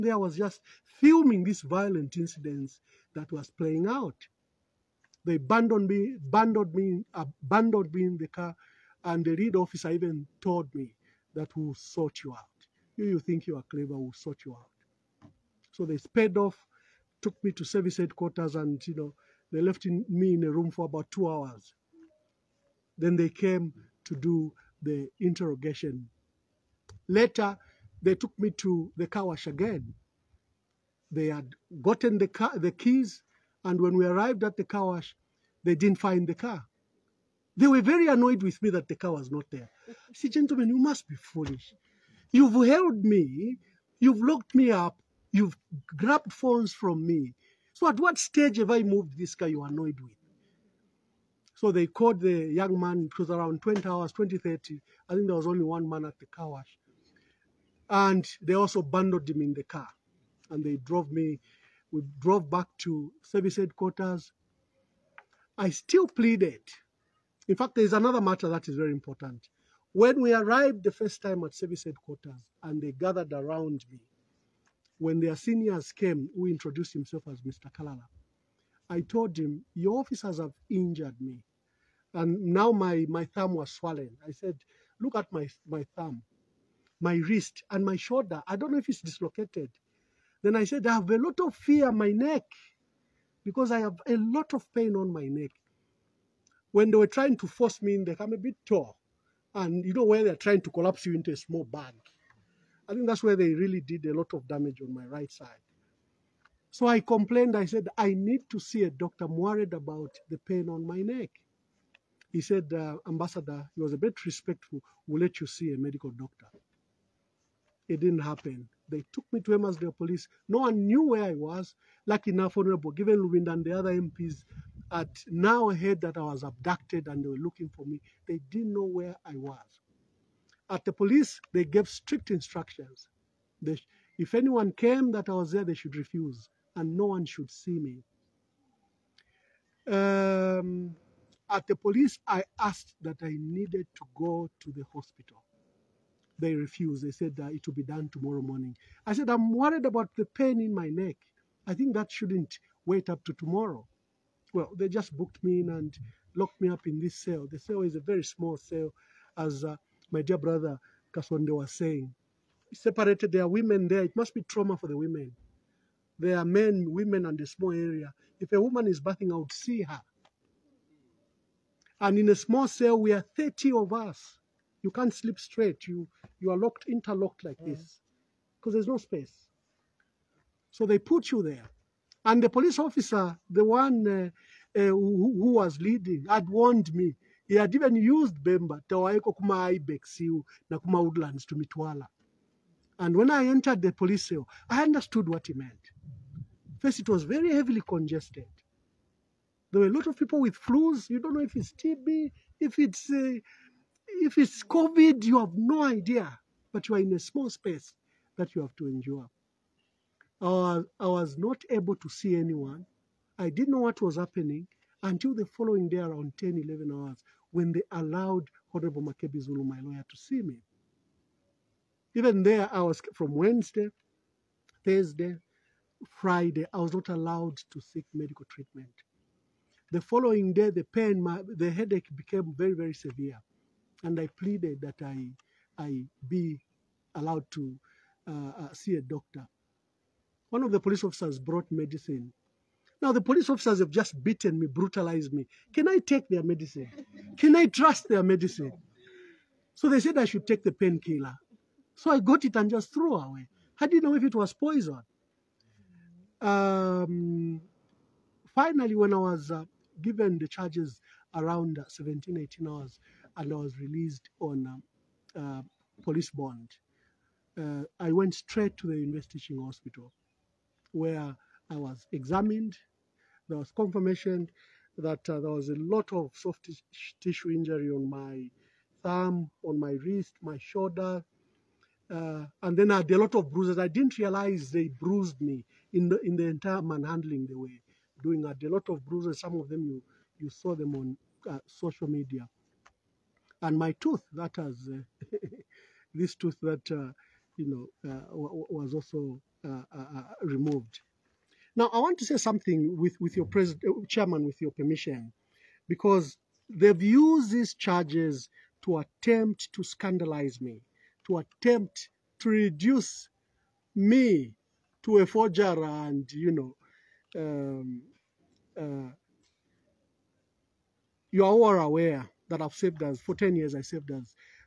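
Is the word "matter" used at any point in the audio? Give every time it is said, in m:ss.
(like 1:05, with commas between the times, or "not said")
1:08.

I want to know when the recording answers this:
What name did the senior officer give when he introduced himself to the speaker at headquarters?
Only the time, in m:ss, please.
1:17.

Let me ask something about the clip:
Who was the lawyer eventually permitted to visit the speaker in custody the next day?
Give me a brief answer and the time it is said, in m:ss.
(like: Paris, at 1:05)
Makebi Zulu, at 3:39.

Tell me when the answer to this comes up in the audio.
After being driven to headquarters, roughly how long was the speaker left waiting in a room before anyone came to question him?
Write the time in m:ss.
0:21.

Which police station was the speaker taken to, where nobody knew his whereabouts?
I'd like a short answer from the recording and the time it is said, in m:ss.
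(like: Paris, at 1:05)
Emmasdale Police, at 1:59.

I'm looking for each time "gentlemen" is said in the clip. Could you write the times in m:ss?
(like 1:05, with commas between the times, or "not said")
0:40.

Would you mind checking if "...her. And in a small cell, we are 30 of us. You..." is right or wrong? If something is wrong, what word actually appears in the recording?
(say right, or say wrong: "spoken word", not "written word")
right.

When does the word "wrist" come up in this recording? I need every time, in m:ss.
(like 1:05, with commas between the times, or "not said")
1:27, 4:39.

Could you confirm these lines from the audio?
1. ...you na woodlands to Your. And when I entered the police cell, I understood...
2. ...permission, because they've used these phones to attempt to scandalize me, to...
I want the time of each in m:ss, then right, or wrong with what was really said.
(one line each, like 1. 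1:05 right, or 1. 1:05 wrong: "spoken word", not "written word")
1. 3:10 wrong: "Mitwala", not "Your"
2. 5:04 wrong: "charges", not "phones".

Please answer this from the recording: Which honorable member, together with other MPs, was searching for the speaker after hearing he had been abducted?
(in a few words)
Given Lubinda.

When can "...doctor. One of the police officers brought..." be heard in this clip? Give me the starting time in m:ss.
3:59.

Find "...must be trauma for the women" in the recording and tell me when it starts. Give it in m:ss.
2:44.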